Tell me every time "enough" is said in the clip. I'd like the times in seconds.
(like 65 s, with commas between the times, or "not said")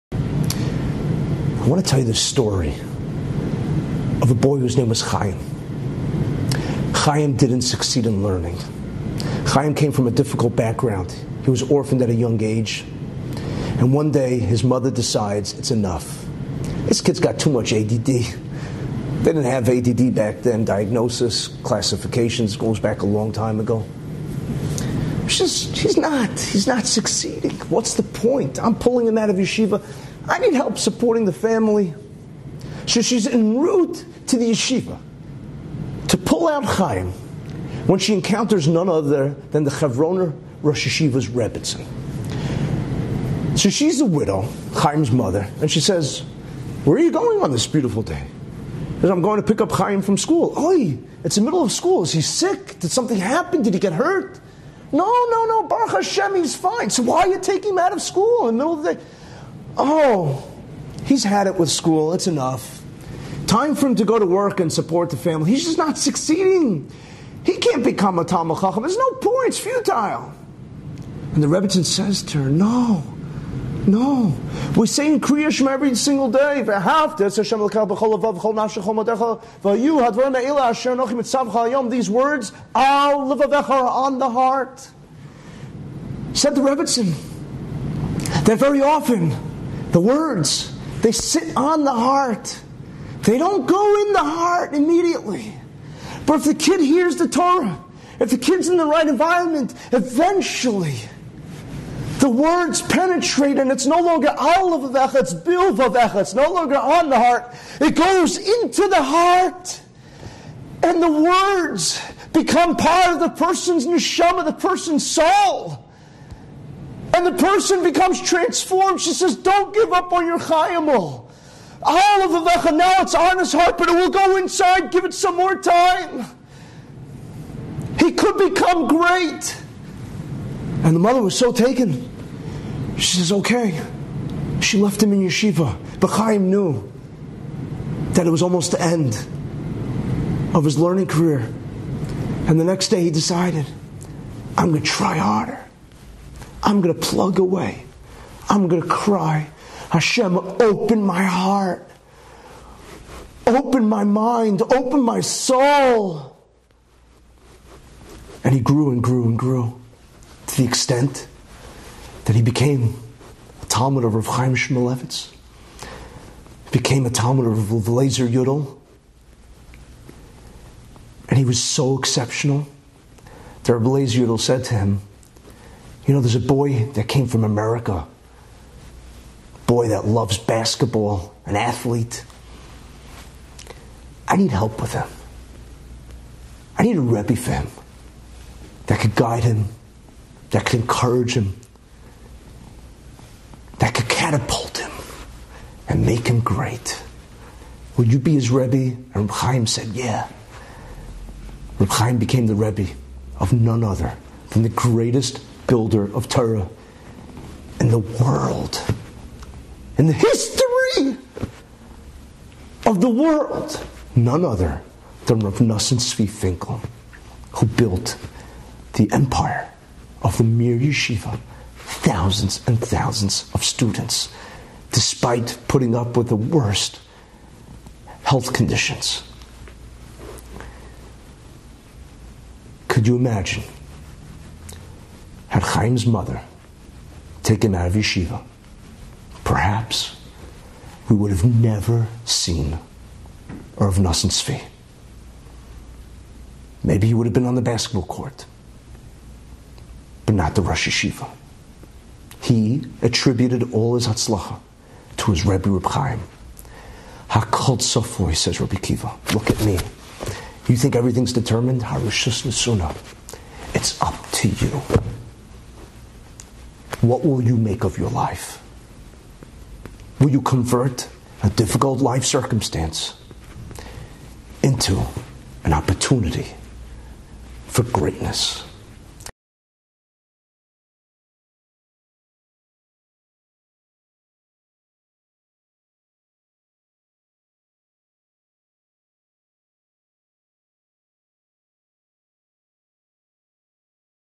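15 s, 62 s.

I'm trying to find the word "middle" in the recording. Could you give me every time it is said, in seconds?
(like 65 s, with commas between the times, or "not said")
51 s, 58 s.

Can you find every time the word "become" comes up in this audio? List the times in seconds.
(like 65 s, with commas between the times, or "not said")
67 s, 112 s, 117 s, 128 s.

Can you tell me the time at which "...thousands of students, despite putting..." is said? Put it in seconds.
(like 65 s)
222 s.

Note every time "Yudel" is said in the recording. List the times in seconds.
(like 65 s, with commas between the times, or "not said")
168 s, 174 s.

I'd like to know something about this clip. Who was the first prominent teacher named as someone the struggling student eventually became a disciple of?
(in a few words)
Rav Chaim Shmulevitz.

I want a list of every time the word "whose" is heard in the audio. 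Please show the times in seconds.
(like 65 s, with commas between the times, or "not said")
4 s.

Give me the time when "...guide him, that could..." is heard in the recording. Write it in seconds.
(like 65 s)
189 s.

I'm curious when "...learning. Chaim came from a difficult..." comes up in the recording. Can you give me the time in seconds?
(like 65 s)
8 s.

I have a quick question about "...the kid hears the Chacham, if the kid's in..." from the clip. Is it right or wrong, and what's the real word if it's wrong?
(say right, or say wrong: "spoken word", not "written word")
wrong: "Torah", not "Chacham".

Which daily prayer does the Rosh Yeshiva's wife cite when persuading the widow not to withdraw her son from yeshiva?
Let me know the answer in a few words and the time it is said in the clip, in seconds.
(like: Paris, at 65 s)
Kriya Shema, at 75 s.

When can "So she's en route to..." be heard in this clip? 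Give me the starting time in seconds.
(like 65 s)
32 s.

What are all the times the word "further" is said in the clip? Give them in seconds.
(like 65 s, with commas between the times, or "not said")
not said.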